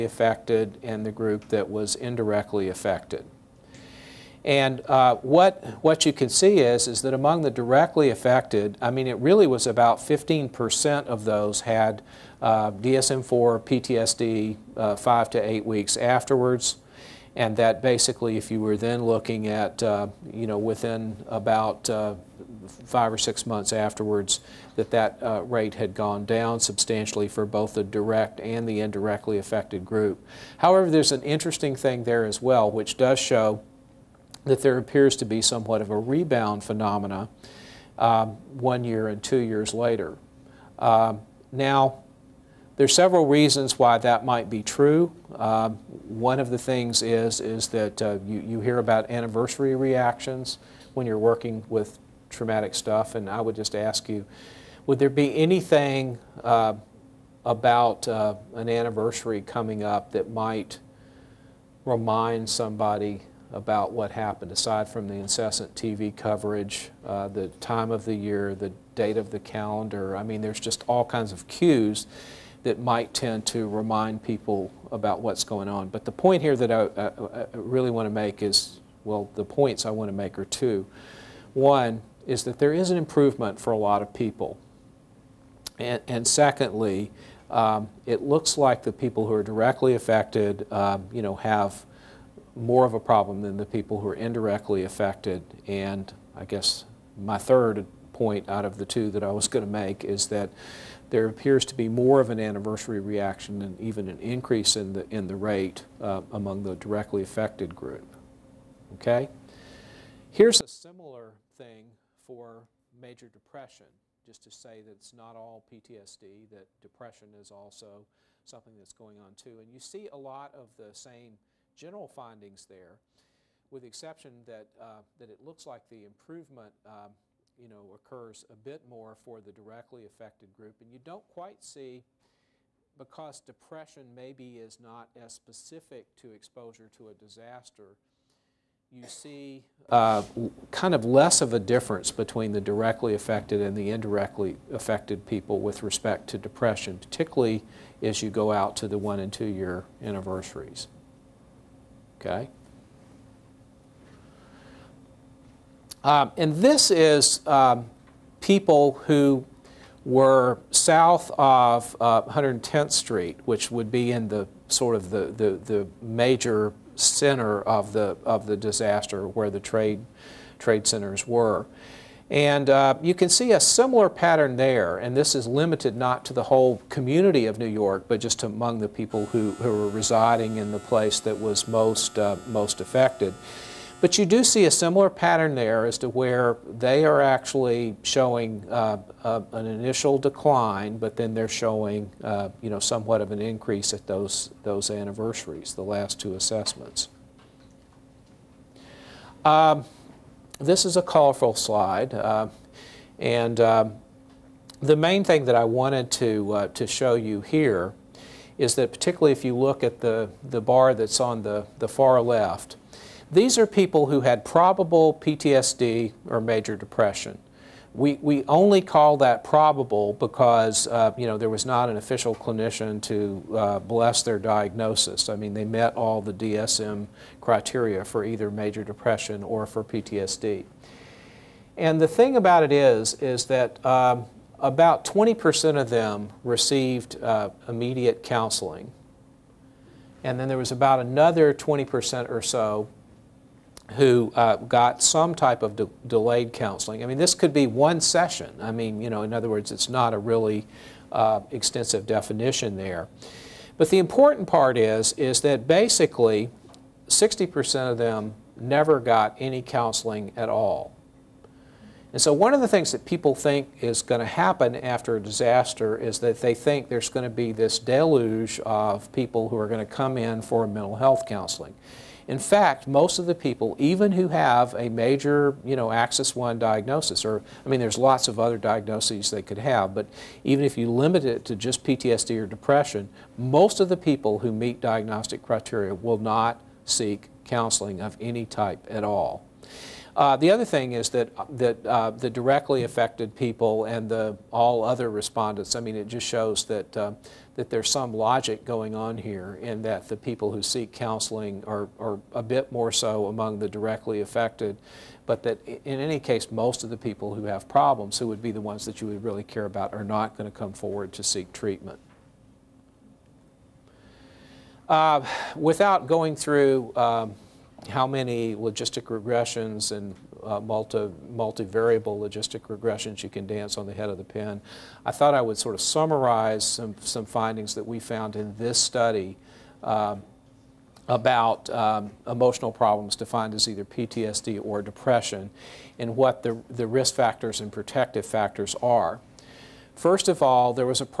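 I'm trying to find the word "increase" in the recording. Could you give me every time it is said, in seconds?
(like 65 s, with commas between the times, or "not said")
104 s, 193 s.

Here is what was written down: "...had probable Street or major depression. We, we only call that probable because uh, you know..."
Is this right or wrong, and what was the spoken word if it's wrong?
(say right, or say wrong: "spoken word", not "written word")
wrong: "PTSD", not "Street".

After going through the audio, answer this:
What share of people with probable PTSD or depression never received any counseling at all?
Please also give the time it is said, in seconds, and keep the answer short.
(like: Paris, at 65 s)
60%, at 257 s.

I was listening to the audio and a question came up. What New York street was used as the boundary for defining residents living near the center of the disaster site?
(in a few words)
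110th Street.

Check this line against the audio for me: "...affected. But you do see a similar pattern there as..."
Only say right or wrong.
right.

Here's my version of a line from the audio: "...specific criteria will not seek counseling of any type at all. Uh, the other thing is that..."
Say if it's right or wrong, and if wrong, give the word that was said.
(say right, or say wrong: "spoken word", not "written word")
wrong: "diagnostic", not "specific".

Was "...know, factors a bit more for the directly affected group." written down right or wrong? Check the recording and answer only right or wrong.
wrong.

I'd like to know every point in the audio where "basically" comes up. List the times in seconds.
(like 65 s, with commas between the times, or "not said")
17 s, 255 s.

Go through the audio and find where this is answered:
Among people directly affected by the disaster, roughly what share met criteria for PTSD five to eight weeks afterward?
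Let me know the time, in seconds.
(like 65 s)
9 s.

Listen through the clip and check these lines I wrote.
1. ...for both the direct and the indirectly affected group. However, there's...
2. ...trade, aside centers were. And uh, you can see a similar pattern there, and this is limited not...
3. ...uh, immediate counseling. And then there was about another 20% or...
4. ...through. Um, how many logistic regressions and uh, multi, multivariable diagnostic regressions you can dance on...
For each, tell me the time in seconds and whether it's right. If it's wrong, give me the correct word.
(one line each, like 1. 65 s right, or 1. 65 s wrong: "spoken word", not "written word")
1. 27 s right
2. 169 s wrong: "trade", not "aside"
3. 237 s right
4. 316 s wrong: "logistic", not "diagnostic".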